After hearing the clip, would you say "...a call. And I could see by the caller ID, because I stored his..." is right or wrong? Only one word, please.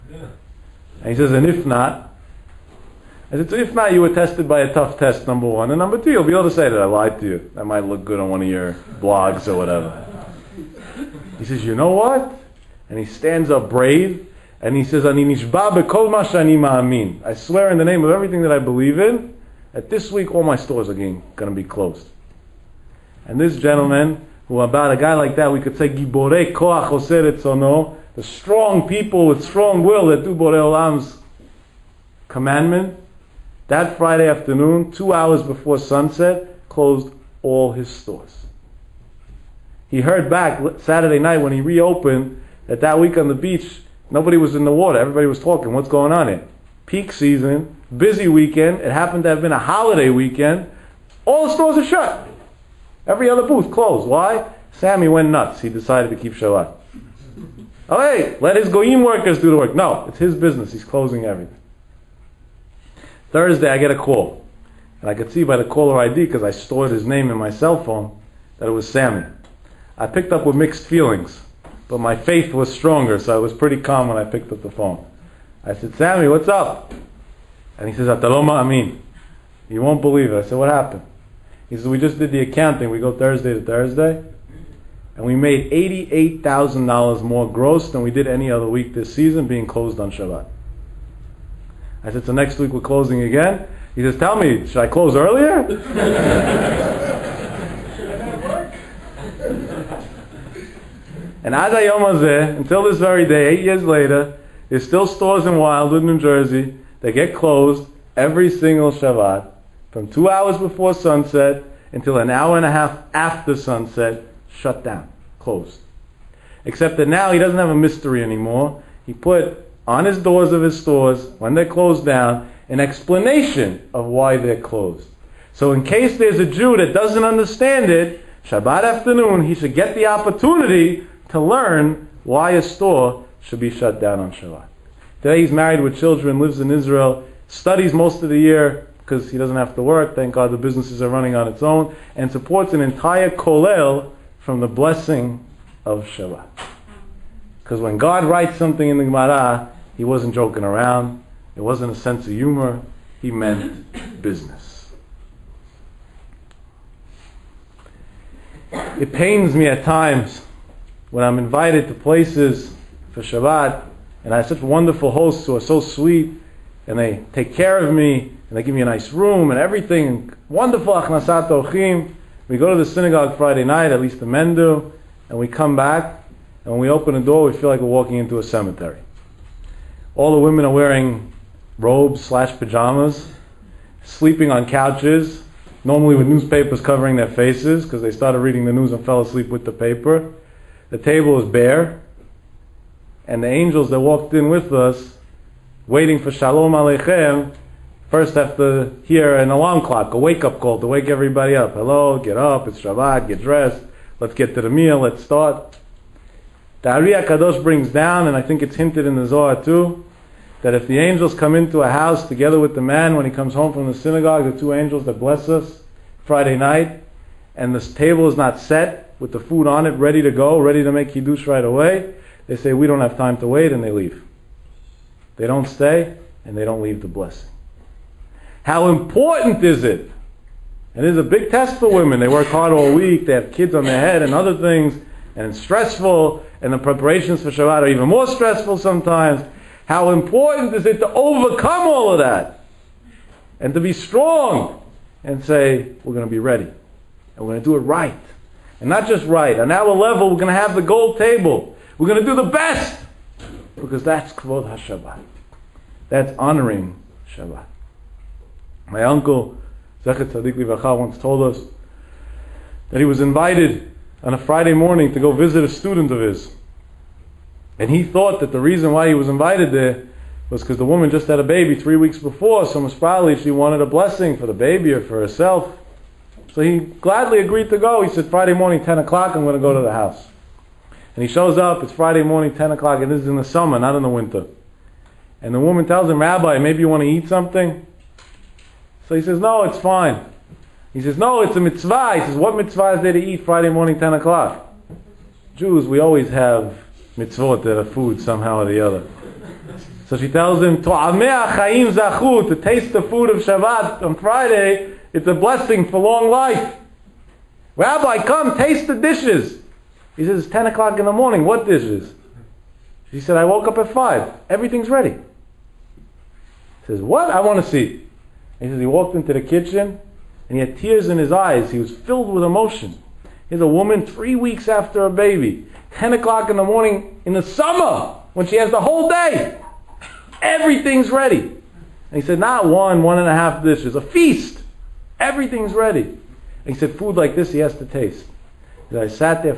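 right.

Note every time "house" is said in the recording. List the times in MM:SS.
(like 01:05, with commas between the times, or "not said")
03:31, 04:39.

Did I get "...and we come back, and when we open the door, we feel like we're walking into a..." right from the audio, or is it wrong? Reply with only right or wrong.
right.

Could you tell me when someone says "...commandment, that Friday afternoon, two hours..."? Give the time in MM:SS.
00:32.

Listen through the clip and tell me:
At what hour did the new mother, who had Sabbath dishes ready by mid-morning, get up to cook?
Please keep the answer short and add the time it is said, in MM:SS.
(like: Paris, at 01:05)
5, at 05:13.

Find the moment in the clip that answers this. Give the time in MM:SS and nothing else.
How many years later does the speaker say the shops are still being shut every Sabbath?
01:43.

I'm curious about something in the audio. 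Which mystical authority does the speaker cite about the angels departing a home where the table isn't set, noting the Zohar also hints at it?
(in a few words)
The Ari HaKadosh.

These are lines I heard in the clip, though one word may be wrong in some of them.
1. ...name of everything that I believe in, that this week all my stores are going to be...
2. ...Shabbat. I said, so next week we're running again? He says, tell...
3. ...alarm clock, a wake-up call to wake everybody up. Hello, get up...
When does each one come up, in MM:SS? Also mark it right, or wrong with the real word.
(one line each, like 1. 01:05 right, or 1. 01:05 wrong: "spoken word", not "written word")
1. 00:17 right
2. 01:30 wrong: "closing", not "running"
3. 03:19 right.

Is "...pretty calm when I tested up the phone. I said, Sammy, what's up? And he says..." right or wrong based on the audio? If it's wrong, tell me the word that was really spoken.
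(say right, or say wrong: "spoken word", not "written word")
wrong: "picked", not "tested".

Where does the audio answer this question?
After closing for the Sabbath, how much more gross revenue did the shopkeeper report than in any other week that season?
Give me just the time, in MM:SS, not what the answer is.
01:25.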